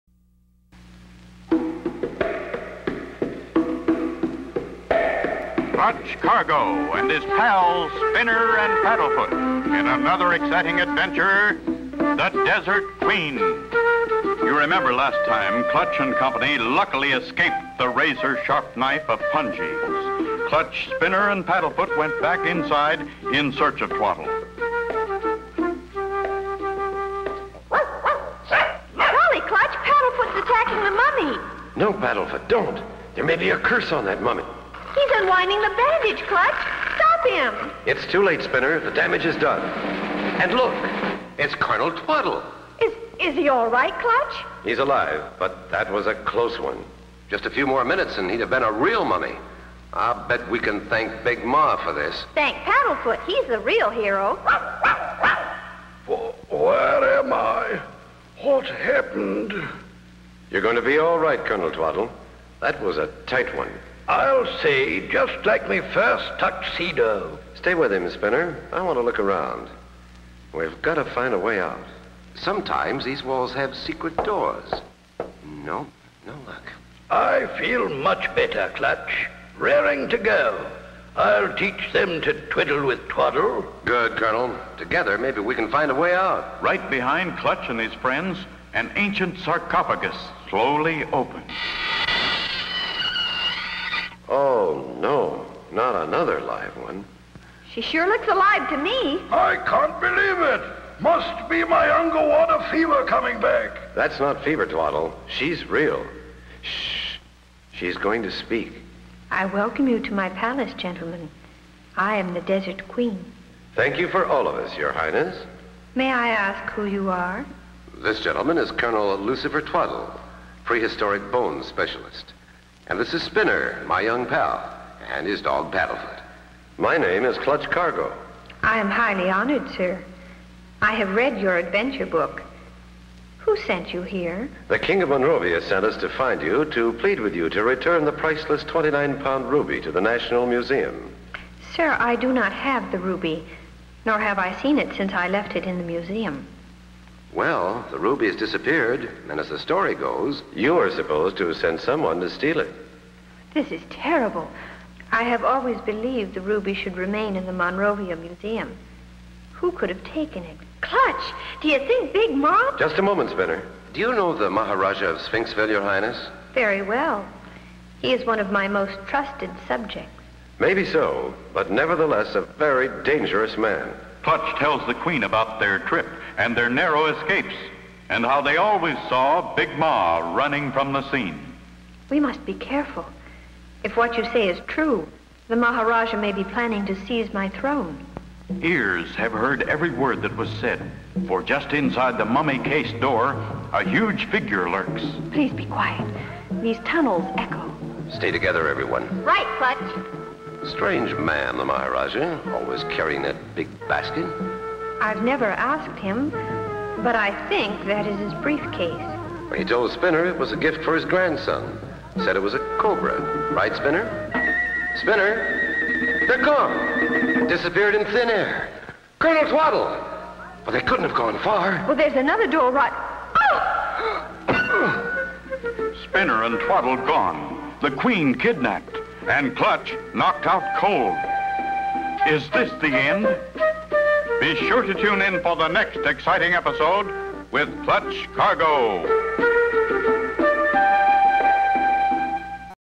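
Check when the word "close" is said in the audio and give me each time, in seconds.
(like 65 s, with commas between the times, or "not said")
46 s.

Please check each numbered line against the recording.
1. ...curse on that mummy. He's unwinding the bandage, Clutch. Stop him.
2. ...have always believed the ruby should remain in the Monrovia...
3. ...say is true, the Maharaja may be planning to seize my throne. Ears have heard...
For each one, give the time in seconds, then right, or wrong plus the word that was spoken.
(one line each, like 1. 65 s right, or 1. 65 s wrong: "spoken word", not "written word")
1. 33 s right
2. 155 s right
3. 184 s right.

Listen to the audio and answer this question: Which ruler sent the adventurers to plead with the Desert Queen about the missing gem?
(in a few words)
The King of Monrovia.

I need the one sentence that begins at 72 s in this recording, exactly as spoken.
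Sometimes these walls have secret doors.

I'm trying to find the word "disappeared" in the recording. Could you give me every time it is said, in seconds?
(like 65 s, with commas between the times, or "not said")
148 s, 217 s.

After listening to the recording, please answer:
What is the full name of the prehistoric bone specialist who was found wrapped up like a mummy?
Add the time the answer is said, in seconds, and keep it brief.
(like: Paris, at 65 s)
Colonel Lucifer Twaddle, at 118 s.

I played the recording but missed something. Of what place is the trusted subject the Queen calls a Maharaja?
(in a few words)
Sphinxville.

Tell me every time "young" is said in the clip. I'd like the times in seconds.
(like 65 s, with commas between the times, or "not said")
124 s.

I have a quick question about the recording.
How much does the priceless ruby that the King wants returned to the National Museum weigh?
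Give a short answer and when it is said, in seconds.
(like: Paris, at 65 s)
29 pounds, at 138 s.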